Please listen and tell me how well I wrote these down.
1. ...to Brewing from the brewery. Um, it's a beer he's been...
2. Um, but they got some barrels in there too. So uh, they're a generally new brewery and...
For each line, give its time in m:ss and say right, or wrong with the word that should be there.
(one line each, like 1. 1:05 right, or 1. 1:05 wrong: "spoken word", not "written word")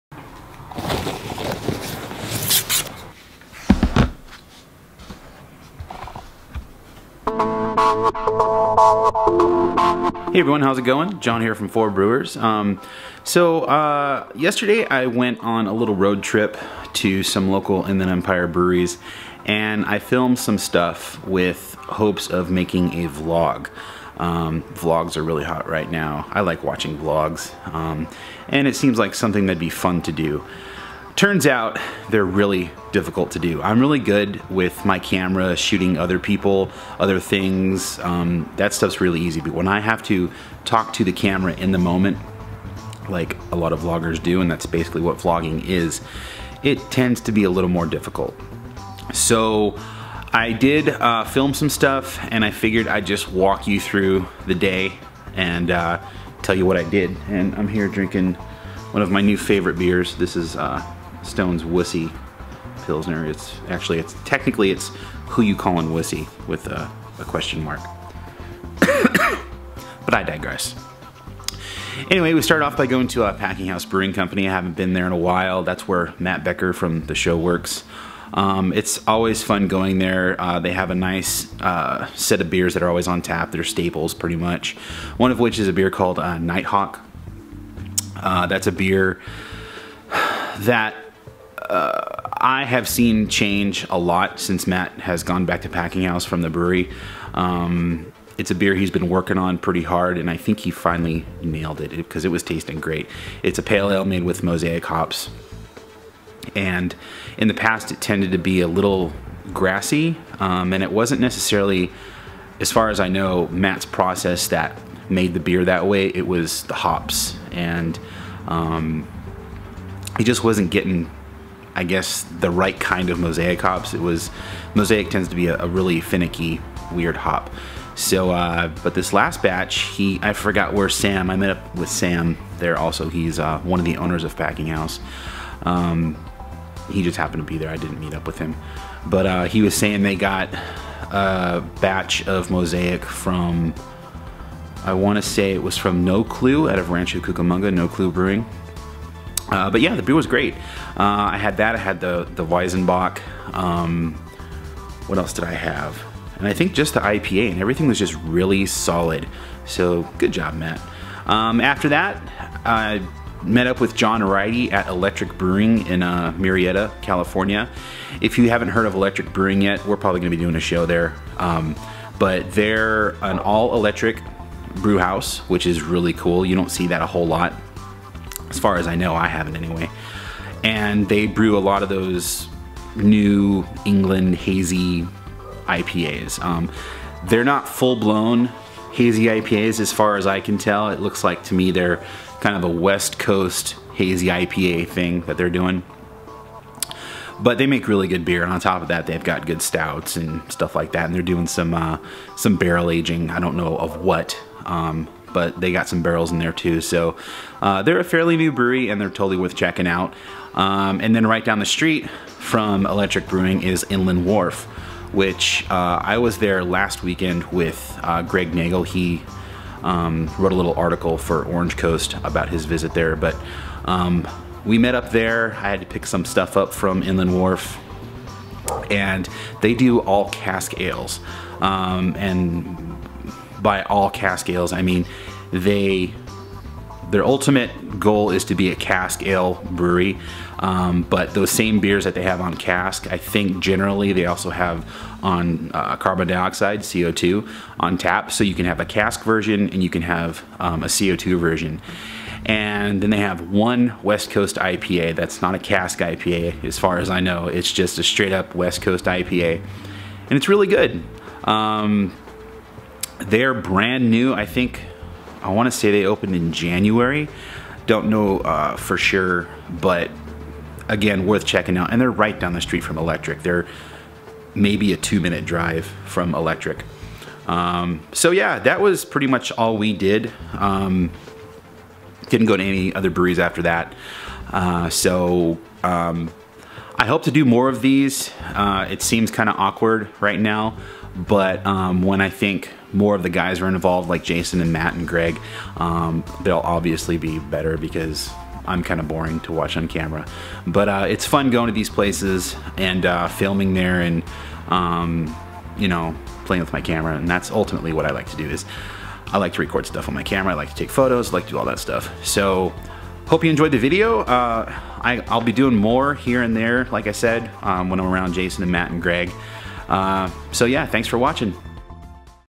1. 1:35 wrong: "Packinghouse", not "Brewing"
2. 3:24 wrong: "fairly", not "generally".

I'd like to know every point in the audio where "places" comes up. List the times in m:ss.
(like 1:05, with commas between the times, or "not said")
5:01.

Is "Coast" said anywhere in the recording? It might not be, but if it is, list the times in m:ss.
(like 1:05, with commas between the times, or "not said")
3:13, 3:41, 4:14, 4:18.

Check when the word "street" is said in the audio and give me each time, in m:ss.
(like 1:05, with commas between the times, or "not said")
3:31, 4:32.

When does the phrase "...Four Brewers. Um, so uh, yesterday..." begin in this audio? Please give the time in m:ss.
0:11.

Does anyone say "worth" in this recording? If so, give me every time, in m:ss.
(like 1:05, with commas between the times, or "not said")
3:29, 4:31.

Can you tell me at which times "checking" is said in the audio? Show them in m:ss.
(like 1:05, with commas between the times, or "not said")
3:29, 4:31.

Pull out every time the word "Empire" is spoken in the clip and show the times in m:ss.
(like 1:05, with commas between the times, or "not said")
0:18.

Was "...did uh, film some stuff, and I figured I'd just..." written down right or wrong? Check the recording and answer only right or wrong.
right.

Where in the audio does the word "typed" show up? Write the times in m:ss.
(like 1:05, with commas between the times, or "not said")
not said.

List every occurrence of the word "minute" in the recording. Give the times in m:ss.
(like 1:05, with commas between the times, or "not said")
4:35.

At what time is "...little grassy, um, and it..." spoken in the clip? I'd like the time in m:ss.
1:48.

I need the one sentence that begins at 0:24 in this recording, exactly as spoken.
Um, vlogs are really hot right now.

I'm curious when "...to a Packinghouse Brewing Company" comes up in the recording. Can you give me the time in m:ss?
1:13.